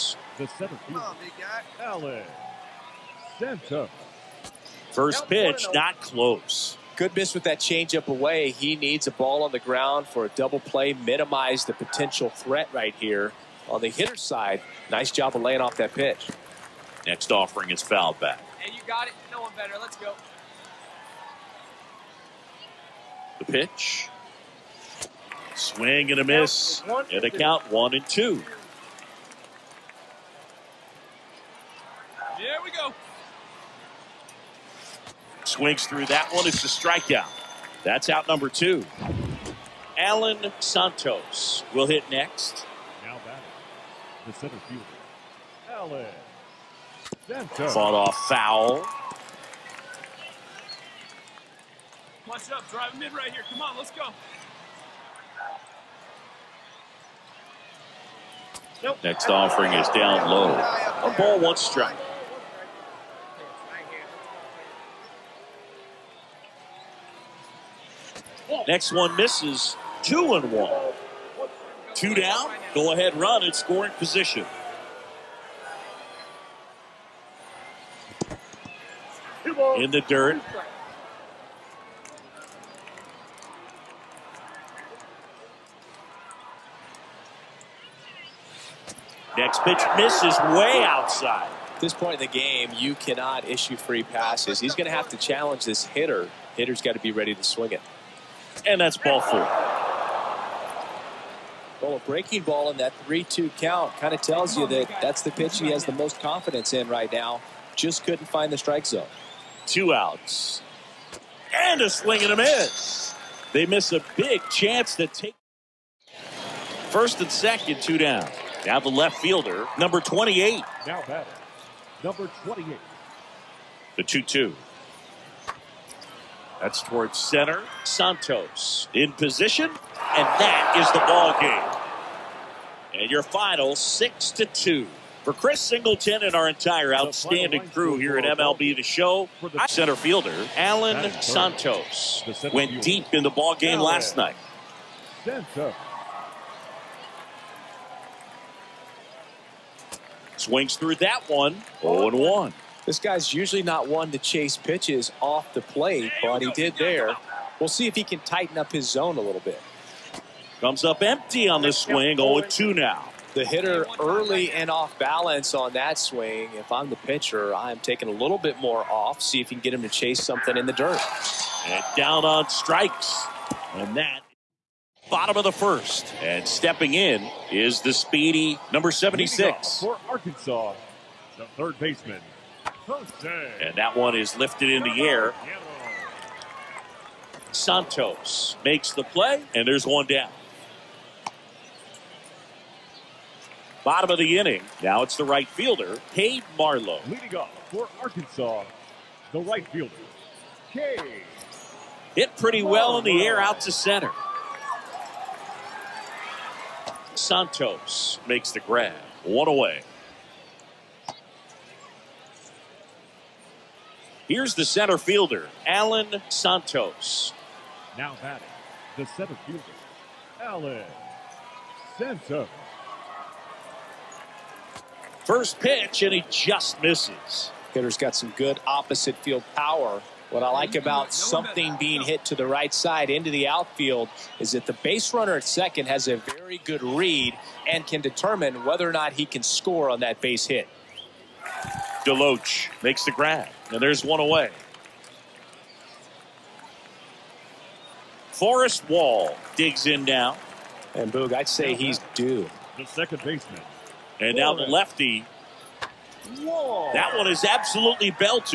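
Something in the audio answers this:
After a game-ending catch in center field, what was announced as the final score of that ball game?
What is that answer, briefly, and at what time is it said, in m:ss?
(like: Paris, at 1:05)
6 to 2, at 2:13.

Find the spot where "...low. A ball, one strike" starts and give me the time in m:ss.
1:00.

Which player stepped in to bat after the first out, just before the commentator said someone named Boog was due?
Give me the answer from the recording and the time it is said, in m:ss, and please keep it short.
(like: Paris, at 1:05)
Forrest Wall, at 4:08.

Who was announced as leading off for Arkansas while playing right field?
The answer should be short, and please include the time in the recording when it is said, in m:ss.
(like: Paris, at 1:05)
Cade Marlowe, at 3:16.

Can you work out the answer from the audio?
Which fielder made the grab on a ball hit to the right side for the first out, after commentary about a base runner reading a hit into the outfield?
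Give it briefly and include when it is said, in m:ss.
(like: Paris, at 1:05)
Deloach, at 4:02.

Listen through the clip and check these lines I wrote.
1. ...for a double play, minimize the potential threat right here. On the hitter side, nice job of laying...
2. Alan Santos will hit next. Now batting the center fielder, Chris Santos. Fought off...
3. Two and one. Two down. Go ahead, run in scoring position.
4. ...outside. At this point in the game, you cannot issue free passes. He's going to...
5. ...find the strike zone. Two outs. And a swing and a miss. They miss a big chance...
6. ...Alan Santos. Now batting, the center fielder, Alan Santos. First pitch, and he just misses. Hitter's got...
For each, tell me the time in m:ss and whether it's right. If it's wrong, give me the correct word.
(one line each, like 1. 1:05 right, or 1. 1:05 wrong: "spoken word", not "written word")
1. 0:10 right
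2. 0:39 wrong: "Alan", not "Chris"
3. 1:10 right
4. 1:30 right
5. 1:48 right
6. 3:35 right.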